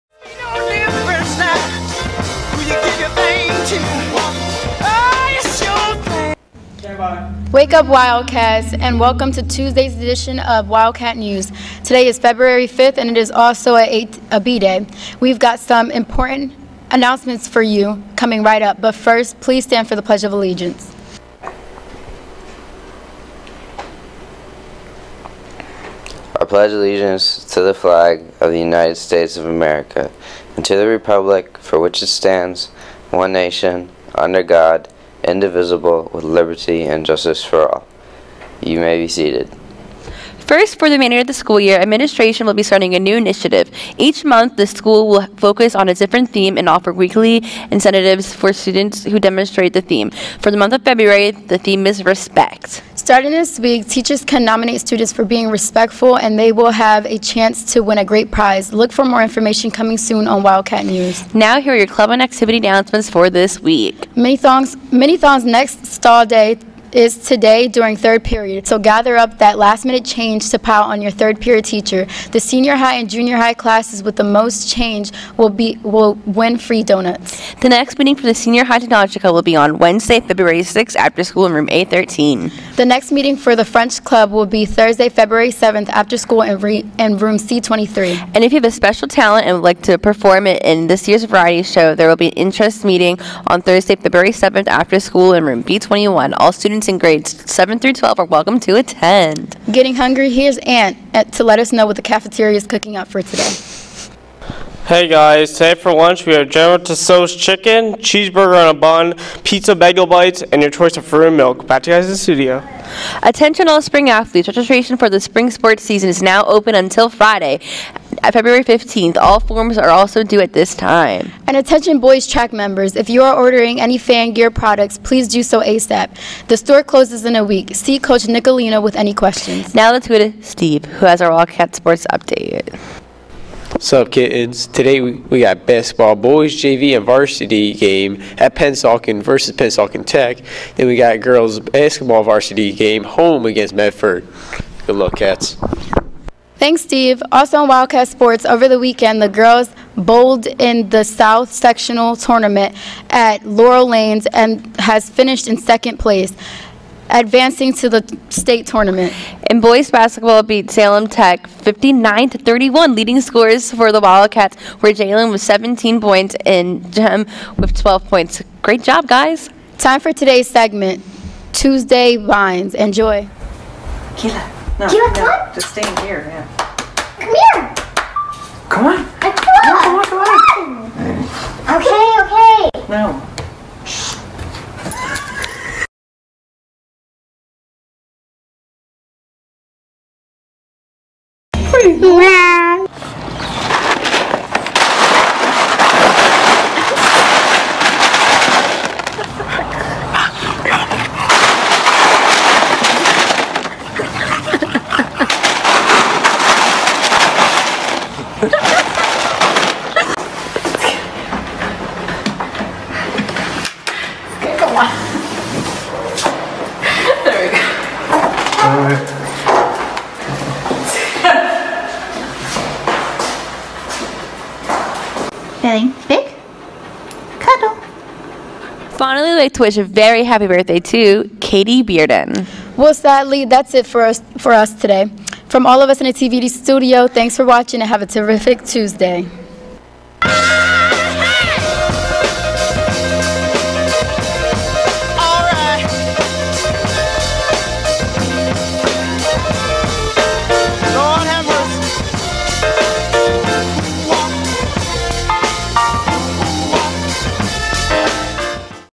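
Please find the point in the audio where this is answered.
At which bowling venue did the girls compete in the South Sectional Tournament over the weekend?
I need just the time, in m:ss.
2:33.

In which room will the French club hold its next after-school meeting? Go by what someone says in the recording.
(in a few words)
C23.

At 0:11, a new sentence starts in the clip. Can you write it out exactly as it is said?
Today is February 5th, and it is also a a B a B day.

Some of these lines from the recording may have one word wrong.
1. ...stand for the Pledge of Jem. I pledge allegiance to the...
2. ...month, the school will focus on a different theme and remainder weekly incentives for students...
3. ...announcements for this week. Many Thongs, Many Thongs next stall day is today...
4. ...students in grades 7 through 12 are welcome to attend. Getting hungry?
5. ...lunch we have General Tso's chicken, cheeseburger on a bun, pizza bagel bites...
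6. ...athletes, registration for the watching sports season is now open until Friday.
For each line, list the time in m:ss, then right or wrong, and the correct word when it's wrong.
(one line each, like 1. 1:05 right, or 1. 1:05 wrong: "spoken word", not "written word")
1. 0:19 wrong: "Allegiance", not "Jem"
2. 0:44 wrong: "offer", not "remainder"
3. 1:02 right
4. 1:36 right
5. 1:45 right
6. 1:54 wrong: "spring", not "watching".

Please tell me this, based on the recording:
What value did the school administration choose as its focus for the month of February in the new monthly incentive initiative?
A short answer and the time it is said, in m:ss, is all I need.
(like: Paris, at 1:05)
Respect, at 0:52.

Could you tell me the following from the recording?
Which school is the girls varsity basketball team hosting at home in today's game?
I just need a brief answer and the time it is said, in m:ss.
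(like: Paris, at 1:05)
Medford, at 2:23.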